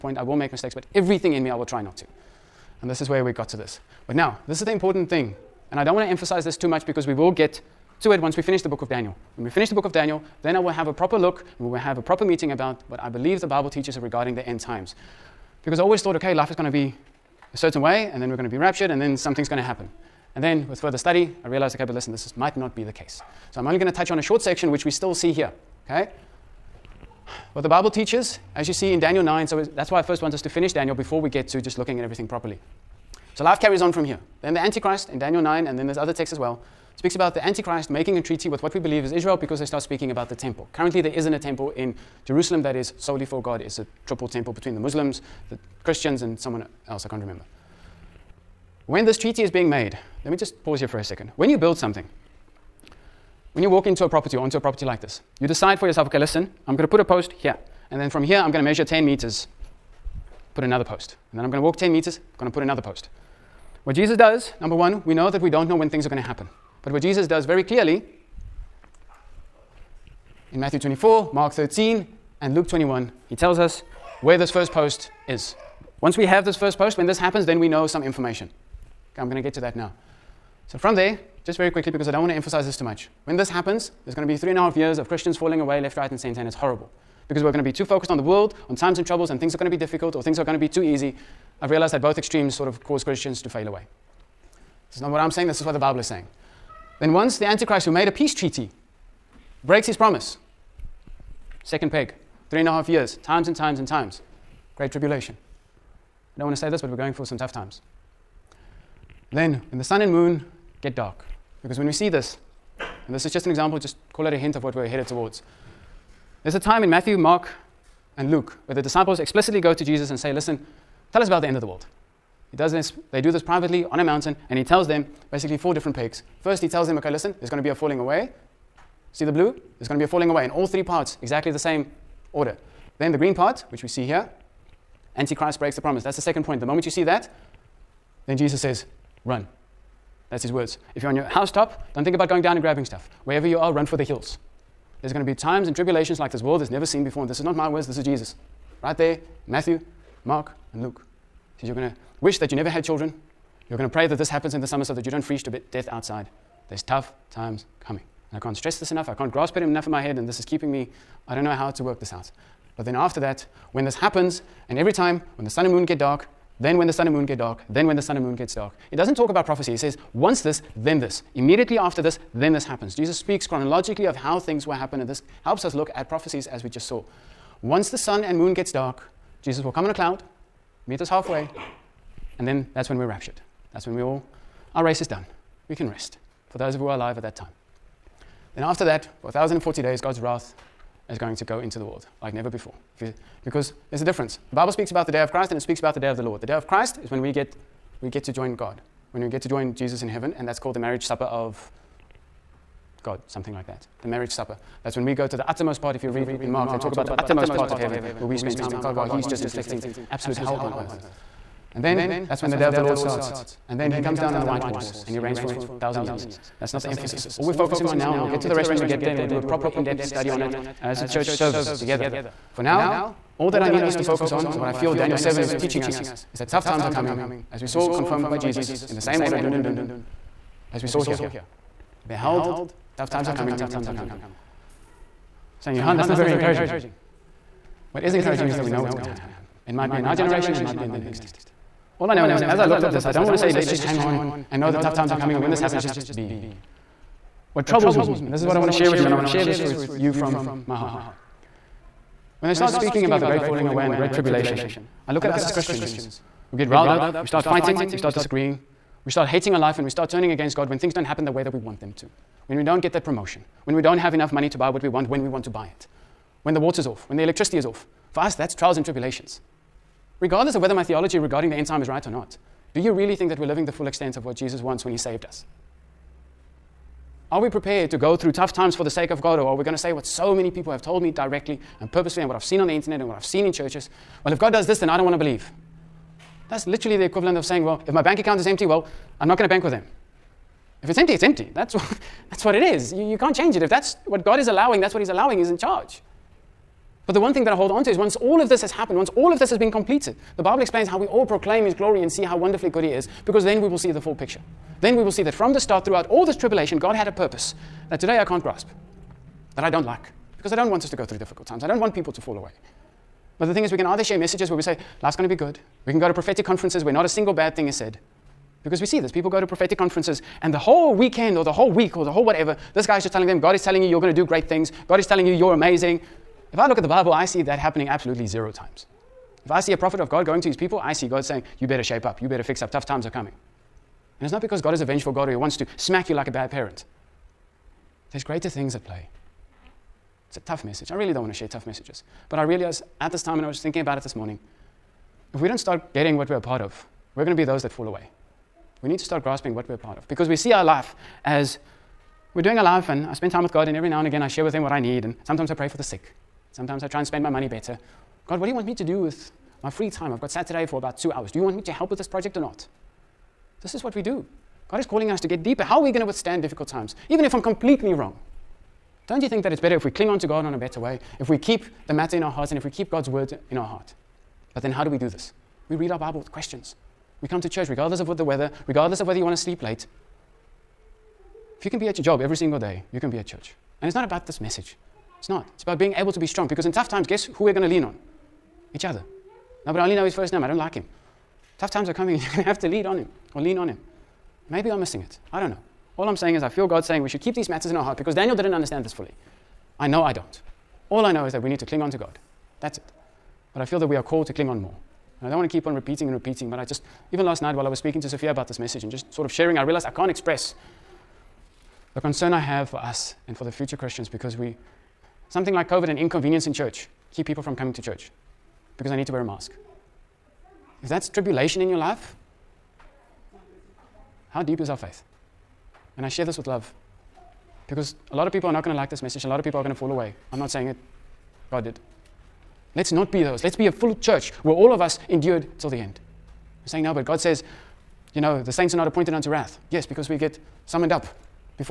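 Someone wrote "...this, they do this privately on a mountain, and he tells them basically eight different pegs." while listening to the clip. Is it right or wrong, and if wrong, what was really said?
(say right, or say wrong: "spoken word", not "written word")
wrong: "four", not "eight".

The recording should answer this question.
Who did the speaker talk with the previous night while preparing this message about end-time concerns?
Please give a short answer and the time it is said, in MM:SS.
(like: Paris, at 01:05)
Sophia, at 06:48.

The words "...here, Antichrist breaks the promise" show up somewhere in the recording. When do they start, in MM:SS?
02:14.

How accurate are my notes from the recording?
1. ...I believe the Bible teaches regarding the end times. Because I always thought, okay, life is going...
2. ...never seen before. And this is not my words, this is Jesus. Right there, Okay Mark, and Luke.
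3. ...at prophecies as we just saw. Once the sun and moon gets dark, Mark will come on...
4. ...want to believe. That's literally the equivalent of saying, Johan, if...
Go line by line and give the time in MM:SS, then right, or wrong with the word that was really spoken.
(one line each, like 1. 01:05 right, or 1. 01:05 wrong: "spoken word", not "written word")
1. 00:12 right
2. 02:26 wrong: "Matthew", not "Okay"
3. 02:55 wrong: "Jesus", not "Mark"
4. 04:45 wrong: "Well", not "Johan".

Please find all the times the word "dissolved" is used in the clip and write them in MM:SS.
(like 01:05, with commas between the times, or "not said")
not said.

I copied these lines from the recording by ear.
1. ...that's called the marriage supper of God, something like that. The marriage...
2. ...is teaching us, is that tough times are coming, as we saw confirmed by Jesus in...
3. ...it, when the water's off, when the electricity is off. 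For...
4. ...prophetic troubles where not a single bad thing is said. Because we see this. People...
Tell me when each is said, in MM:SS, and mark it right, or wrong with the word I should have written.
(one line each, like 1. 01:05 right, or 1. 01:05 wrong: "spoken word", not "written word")
1. 03:20 right
2. 03:45 right
3. 04:25 right
4. 05:16 wrong: "conferences", not "troubles".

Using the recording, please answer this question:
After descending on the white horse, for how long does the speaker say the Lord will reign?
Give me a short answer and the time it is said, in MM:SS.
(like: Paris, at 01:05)
a thousand years, at 03:35.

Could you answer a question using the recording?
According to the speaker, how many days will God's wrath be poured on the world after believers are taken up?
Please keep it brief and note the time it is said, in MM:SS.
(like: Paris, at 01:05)
1040, at 03:09.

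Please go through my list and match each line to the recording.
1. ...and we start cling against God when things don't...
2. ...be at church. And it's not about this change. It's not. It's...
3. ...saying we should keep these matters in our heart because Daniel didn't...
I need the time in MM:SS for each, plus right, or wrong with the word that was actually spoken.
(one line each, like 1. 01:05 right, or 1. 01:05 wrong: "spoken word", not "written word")
1. 04:19 wrong: "turning", not "cling"
2. 06:23 wrong: "message", not "change"
3. 06:36 right.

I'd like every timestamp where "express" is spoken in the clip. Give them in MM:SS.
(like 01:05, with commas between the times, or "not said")
06:50.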